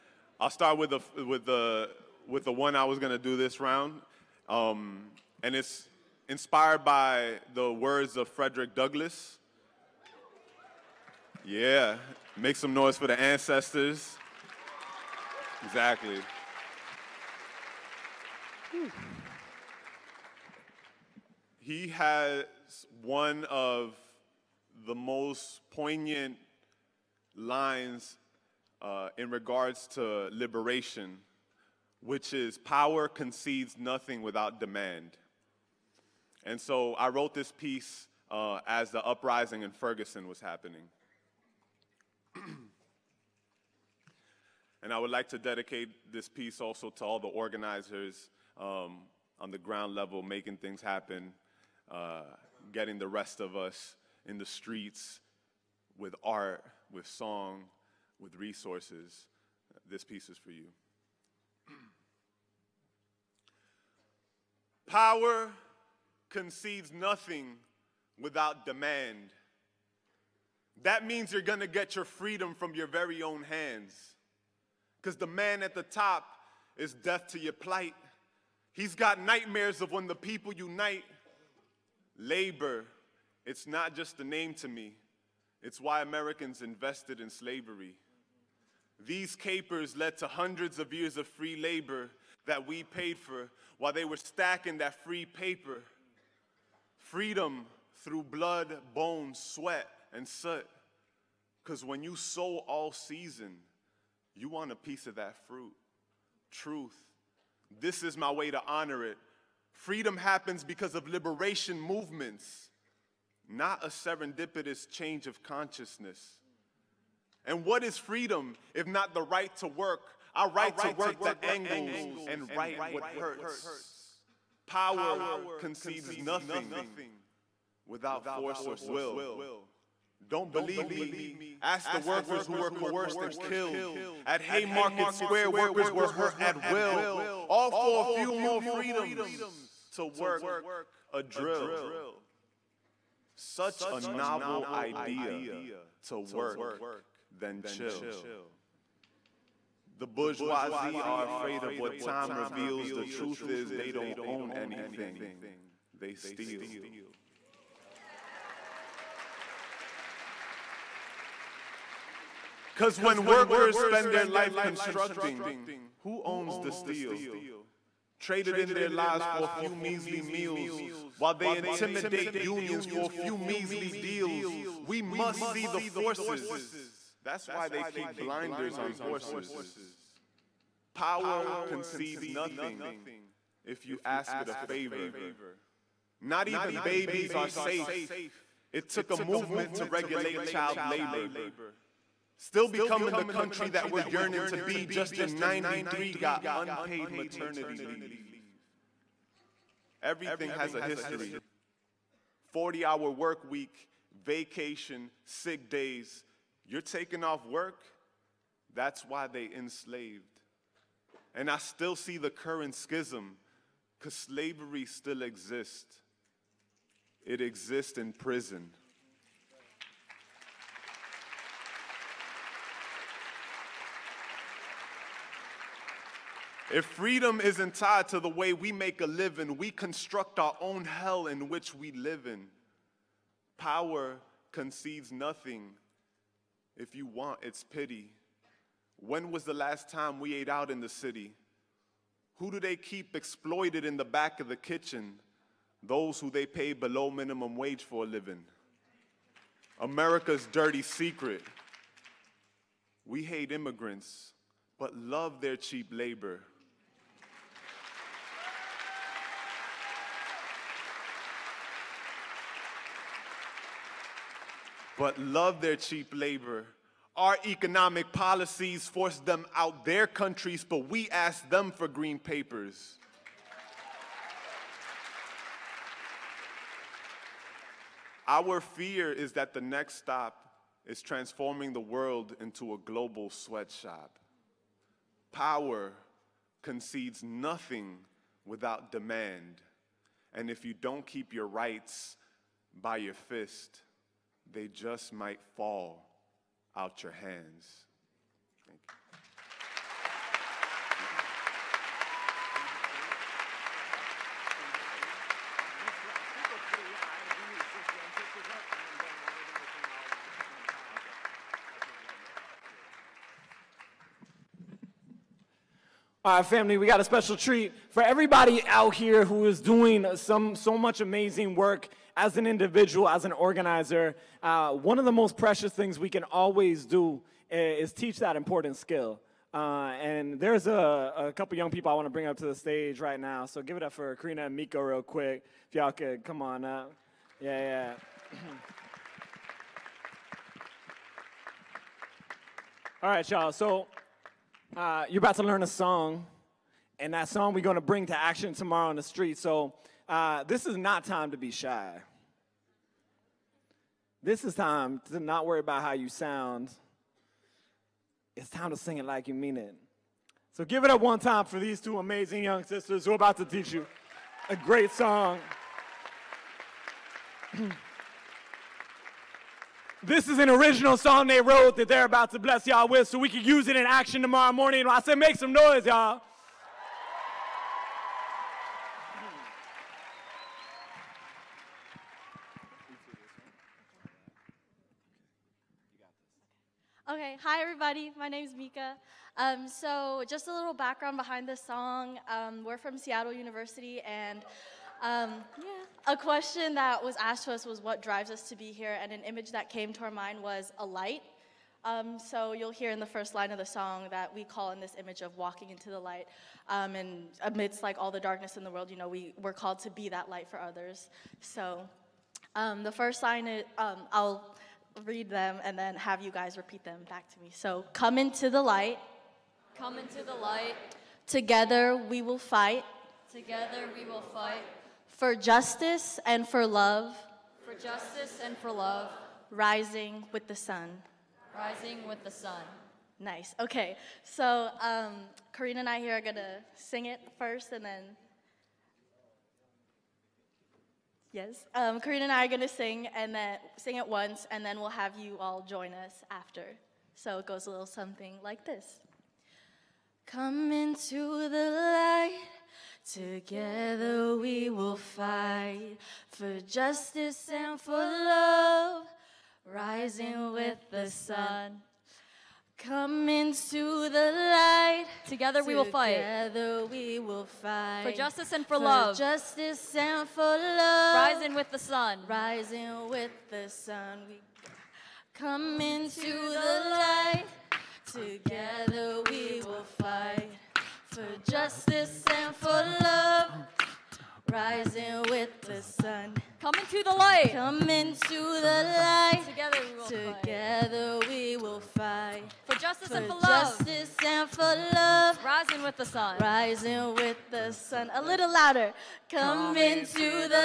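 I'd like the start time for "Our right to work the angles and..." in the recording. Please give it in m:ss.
2:00.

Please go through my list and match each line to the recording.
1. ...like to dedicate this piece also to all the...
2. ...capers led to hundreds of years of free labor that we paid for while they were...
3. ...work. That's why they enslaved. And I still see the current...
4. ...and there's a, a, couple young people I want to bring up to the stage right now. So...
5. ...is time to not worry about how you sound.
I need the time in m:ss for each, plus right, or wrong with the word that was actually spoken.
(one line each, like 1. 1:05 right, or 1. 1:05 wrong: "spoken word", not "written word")
1. 0:45 right
2. 1:29 right
3. 3:27 right
4. 5:30 right
5. 5:54 right.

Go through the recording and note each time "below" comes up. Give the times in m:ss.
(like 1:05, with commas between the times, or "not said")
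4:06.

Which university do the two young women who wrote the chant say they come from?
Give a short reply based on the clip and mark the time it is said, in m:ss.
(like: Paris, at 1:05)
Seattle University, at 6:32.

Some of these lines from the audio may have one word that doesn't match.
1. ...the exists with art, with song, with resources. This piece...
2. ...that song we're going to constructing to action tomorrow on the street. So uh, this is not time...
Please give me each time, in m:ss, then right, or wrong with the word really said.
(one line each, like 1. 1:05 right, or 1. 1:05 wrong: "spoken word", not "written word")
1. 0:54 wrong: "streets", not "exists"
2. 5:47 wrong: "bring", not "constructing".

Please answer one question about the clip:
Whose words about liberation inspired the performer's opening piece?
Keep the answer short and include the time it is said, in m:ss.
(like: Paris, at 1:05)
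Frederick Douglass, at 0:08.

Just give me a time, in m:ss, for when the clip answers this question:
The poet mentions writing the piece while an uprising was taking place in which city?
0:39.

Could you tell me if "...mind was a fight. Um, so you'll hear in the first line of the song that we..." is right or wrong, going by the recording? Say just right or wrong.
wrong.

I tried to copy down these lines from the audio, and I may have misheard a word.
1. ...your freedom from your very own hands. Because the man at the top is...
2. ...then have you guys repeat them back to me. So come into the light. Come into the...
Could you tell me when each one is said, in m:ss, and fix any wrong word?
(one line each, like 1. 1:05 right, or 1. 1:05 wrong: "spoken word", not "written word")
1. 1:11 right
2. 6:55 right.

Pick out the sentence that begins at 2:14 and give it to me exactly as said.
At Haymarket Square, workers were hurt at will, all for a few more freedoms to work a drill.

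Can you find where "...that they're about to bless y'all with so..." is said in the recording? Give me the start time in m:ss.
6:11.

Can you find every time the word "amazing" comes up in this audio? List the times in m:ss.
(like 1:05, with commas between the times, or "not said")
5:20, 6:01.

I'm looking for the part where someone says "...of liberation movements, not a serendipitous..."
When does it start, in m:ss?
1:50.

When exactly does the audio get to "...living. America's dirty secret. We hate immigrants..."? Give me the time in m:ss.
4:08.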